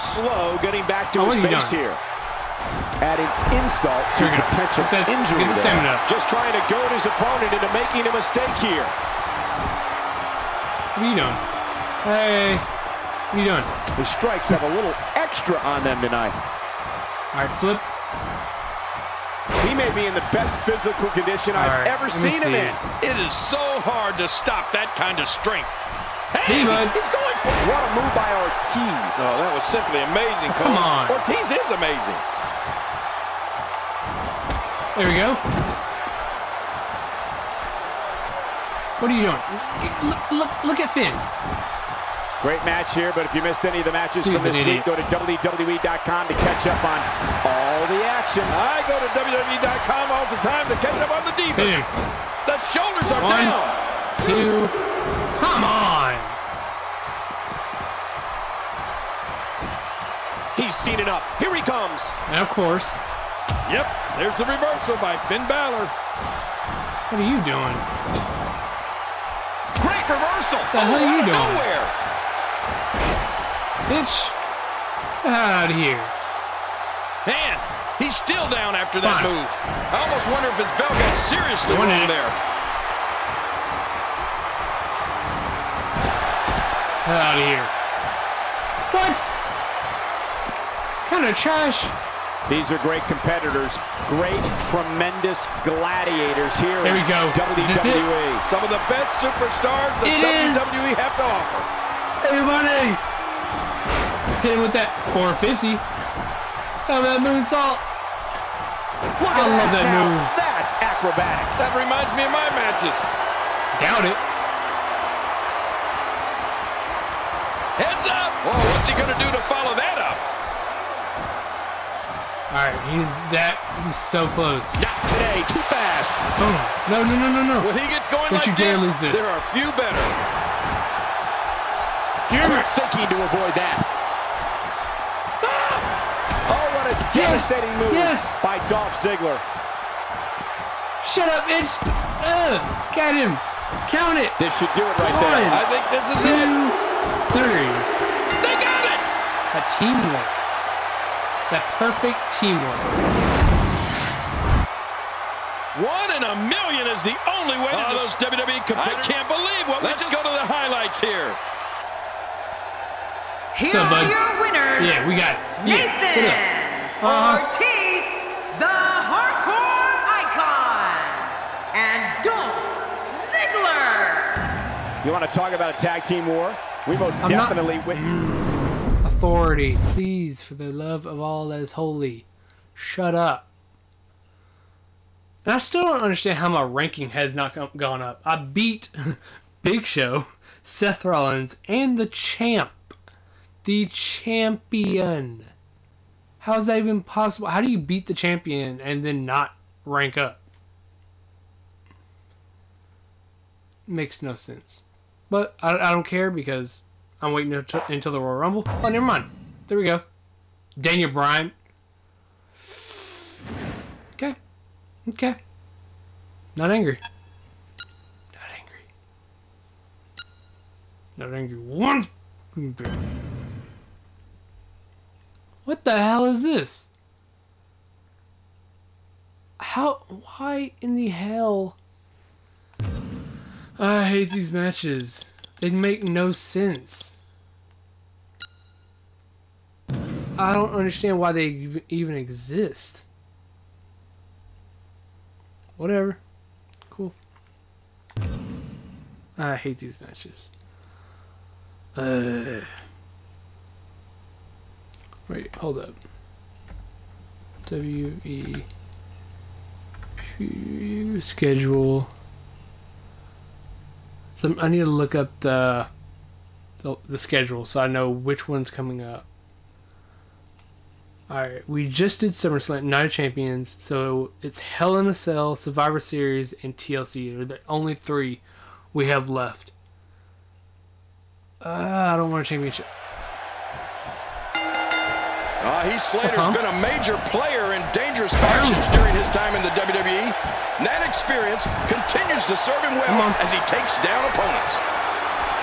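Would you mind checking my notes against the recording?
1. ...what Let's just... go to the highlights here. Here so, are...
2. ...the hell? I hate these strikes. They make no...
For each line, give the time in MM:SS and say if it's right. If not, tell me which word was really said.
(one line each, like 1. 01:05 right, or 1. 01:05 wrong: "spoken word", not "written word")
1. 02:39 right
2. 03:50 wrong: "matches", not "strikes".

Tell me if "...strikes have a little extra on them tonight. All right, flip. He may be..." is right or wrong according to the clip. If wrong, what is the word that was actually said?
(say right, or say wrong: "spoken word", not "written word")
right.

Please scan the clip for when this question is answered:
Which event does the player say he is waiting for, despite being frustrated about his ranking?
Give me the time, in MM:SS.
03:28.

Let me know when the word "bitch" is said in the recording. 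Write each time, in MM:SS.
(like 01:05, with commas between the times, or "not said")
01:13, 02:21.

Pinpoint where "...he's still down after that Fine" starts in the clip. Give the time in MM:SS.
01:18.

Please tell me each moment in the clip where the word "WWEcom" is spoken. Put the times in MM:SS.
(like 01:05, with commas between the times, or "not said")
00:45, 00:49.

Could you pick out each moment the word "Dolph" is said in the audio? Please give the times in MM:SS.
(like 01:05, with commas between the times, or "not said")
02:18, 02:52.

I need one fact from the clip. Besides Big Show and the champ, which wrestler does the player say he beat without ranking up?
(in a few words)
Seth Rollins.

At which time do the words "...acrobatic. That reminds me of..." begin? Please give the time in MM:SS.
01:50.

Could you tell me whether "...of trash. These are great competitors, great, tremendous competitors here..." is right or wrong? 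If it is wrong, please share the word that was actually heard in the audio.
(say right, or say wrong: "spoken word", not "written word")
wrong: "gladiators", not "competitors".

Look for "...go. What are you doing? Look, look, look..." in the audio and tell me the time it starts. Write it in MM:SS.
00:35.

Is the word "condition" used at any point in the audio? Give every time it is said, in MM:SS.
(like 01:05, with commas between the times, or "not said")
00:21.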